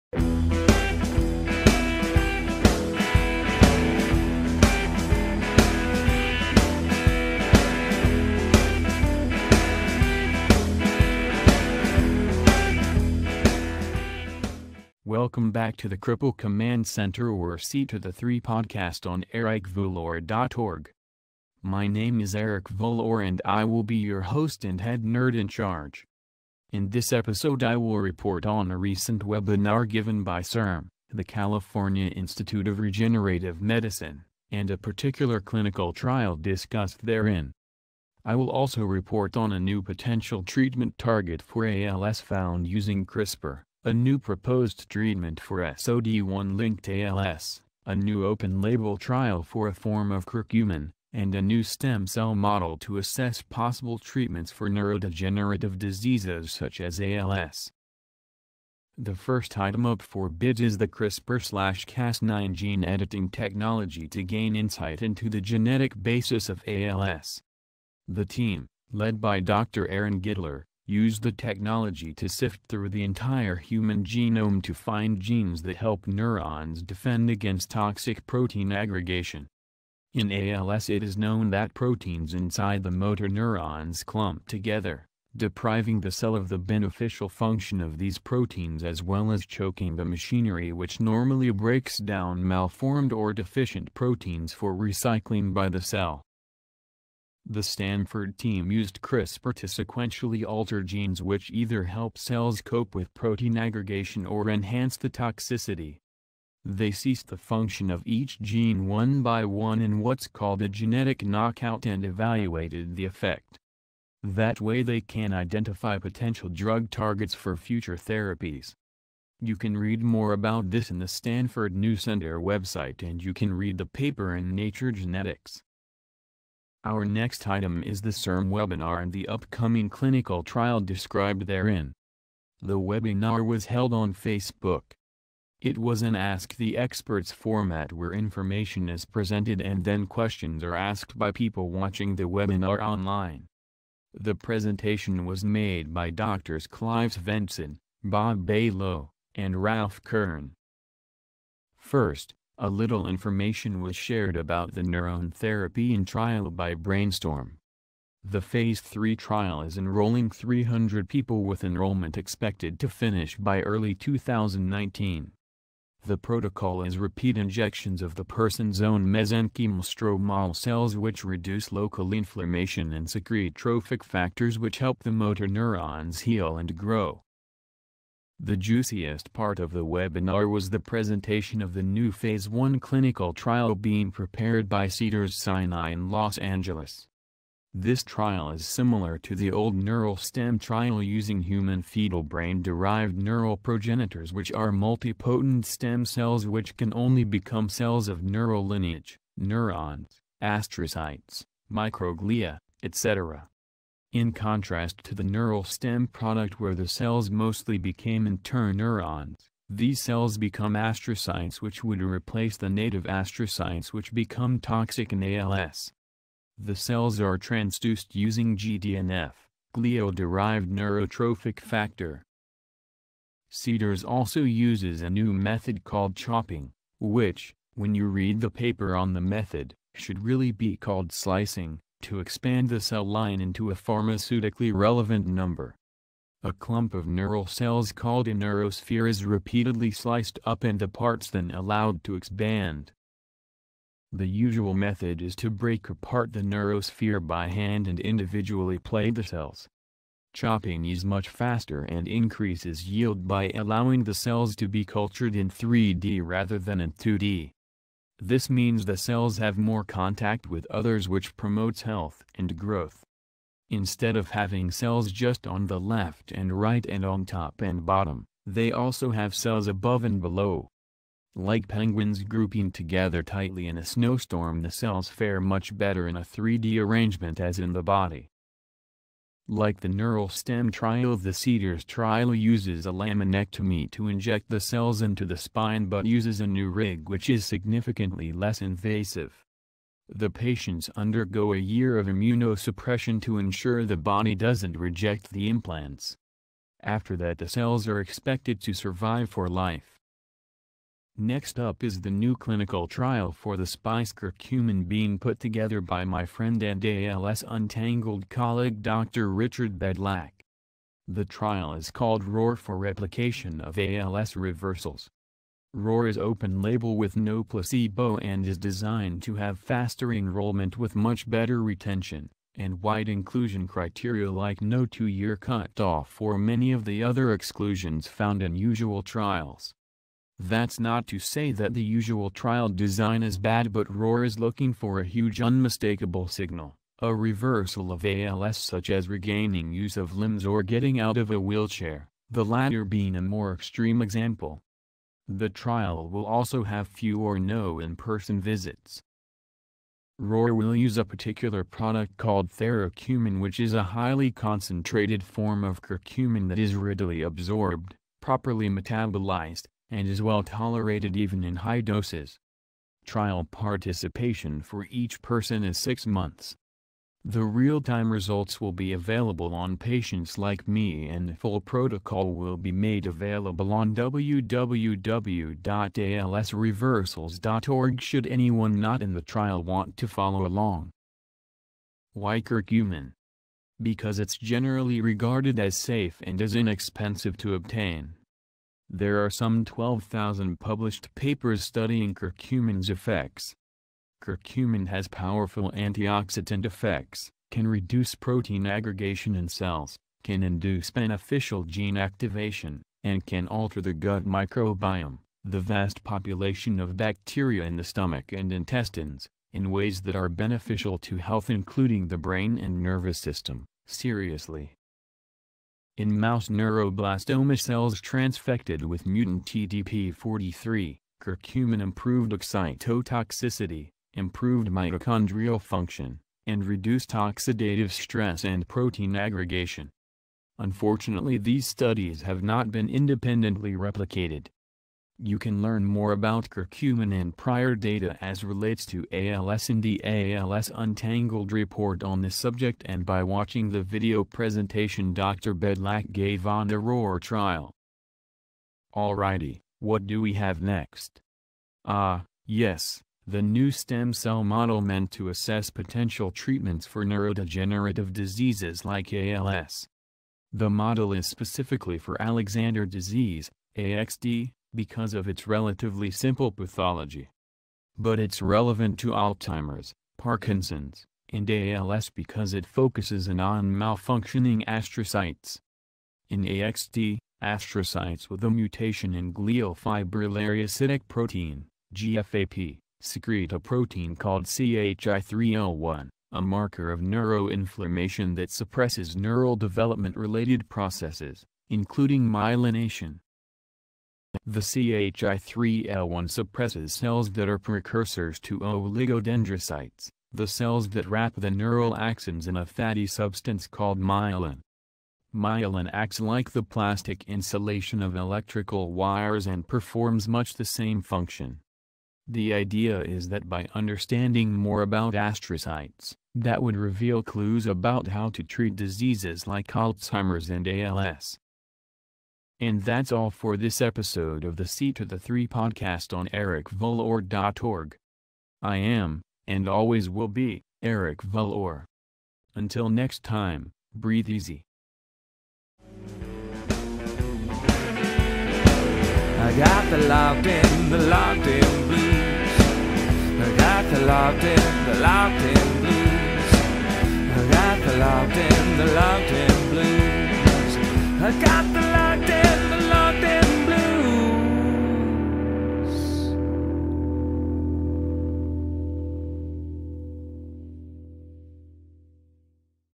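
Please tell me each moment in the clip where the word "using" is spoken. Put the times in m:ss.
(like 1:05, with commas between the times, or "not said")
0:42, 3:11, 3:38.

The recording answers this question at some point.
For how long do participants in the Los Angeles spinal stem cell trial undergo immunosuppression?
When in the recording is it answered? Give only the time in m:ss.
4:51.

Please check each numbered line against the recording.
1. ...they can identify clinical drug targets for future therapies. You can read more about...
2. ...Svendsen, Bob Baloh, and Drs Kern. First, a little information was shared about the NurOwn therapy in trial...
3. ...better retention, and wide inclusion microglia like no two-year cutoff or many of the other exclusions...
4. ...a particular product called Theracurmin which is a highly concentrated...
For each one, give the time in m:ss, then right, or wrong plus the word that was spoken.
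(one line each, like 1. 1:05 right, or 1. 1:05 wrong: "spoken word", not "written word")
1. 1:54 wrong: "potential", not "clinical"
2. 2:27 wrong: "Ralph", not "Drs"
3. 5:21 wrong: "criteria", not "microglia"
4. 5:50 right.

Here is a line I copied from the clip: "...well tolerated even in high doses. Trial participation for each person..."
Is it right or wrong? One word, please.
right.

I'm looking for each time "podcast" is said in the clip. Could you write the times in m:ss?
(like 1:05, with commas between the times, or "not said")
0:18, 8:45.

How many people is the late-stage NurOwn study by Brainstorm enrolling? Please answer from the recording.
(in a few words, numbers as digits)
300.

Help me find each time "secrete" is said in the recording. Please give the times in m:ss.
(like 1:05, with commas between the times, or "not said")
2:53, 8:03.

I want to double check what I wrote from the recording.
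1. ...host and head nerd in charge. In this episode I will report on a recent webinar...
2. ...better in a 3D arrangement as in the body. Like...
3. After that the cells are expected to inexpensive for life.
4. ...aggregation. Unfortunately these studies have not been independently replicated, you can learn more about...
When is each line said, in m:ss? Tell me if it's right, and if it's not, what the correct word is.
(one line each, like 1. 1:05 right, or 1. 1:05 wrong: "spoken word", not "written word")
1. 0:24 right
2. 4:35 right
3. 4:56 wrong: "survive", not "inexpensive"
4. 7:09 right.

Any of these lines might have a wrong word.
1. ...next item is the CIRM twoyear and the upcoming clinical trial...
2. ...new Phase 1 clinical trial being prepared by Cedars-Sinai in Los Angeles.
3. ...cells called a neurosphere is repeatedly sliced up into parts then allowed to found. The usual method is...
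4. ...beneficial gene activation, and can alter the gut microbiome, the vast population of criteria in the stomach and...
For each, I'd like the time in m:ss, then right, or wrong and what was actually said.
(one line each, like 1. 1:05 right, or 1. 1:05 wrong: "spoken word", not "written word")
1. 2:07 wrong: "webinar", not "twoyear"
2. 3:01 right
3. 3:57 wrong: "expand", not "found"
4. 6:40 wrong: "bacteria", not "criteria".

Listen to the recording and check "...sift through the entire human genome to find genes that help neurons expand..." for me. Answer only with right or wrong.
wrong.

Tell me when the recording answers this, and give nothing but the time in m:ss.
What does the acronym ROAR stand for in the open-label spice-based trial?
5:12.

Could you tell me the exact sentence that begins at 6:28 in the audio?
There are some 12,000 published papers studying curcumin's effects.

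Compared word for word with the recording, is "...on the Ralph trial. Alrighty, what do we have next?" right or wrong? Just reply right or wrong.
wrong.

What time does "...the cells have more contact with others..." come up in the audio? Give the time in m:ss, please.
4:18.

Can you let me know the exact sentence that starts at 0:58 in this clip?
The first item up for bid is the CRISPR-Cas9 gene editing technology to gain insight into the genetic basis of ALS.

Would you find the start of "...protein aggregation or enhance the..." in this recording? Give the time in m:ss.
1:43.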